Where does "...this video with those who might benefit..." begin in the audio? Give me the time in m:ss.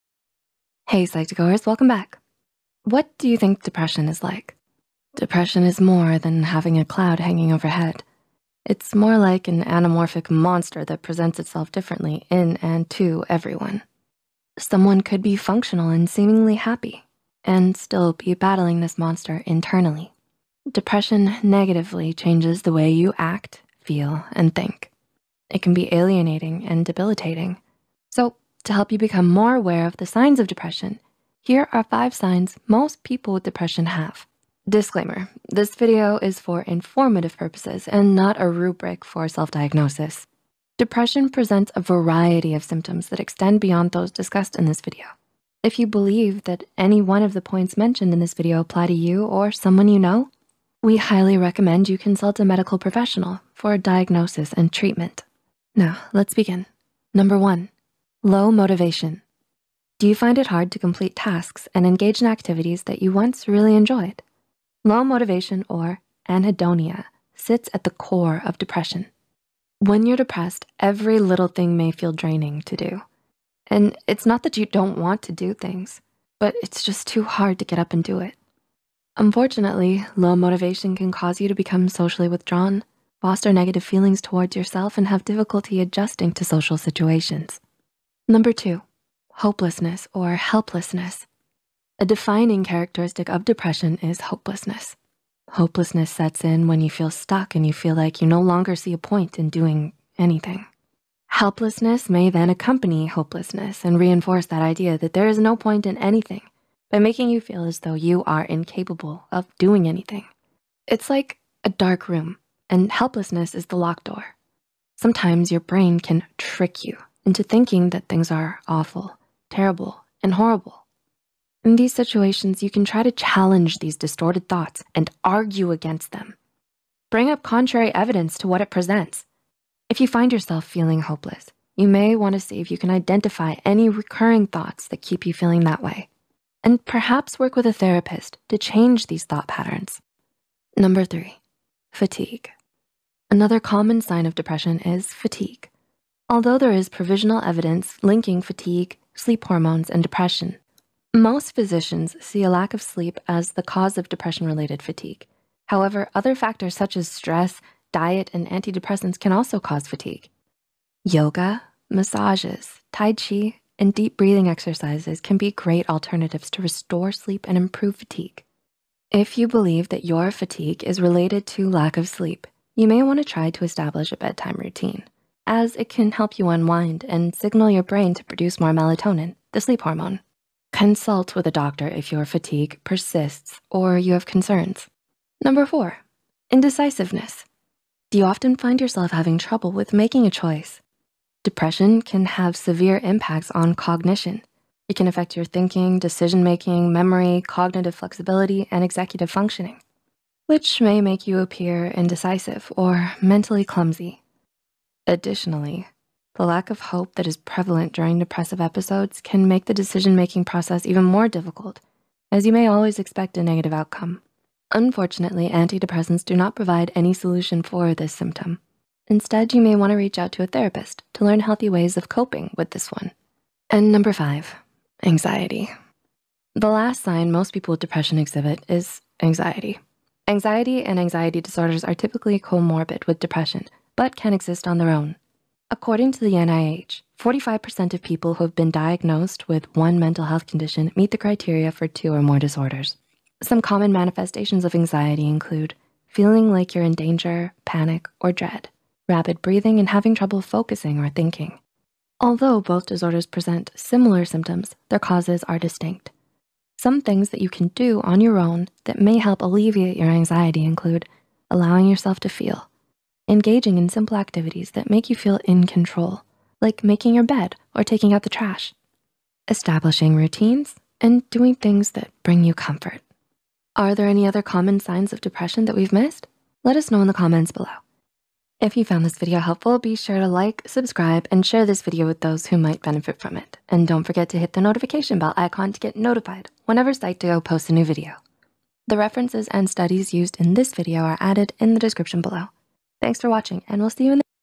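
4:41.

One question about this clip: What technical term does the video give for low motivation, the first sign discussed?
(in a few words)
anhedonia.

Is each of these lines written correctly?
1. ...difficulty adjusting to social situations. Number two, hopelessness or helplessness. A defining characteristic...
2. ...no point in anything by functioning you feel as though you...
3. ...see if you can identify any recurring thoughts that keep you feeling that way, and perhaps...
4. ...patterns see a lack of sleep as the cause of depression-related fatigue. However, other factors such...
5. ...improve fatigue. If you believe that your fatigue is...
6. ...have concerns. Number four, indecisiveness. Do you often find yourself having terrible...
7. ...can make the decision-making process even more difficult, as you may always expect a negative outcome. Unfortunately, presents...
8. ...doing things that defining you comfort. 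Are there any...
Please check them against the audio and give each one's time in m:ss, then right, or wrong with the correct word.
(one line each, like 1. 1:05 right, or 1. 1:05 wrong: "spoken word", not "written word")
1. 1:25 right
2. 1:45 wrong: "making", not "functioning"
3. 2:12 right
4. 2:31 wrong: "physicians", not "patterns"
5. 2:47 right
6. 3:04 wrong: "trouble", not "terrible"
7. 3:29 wrong: "antidepressants", not "presents"
8. 4:31 wrong: "bring", not "defining".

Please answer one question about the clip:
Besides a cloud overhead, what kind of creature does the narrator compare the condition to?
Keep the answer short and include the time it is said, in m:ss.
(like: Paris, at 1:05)
anamorphic monster, at 0:09.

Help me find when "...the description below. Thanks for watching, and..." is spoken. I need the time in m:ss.
4:51.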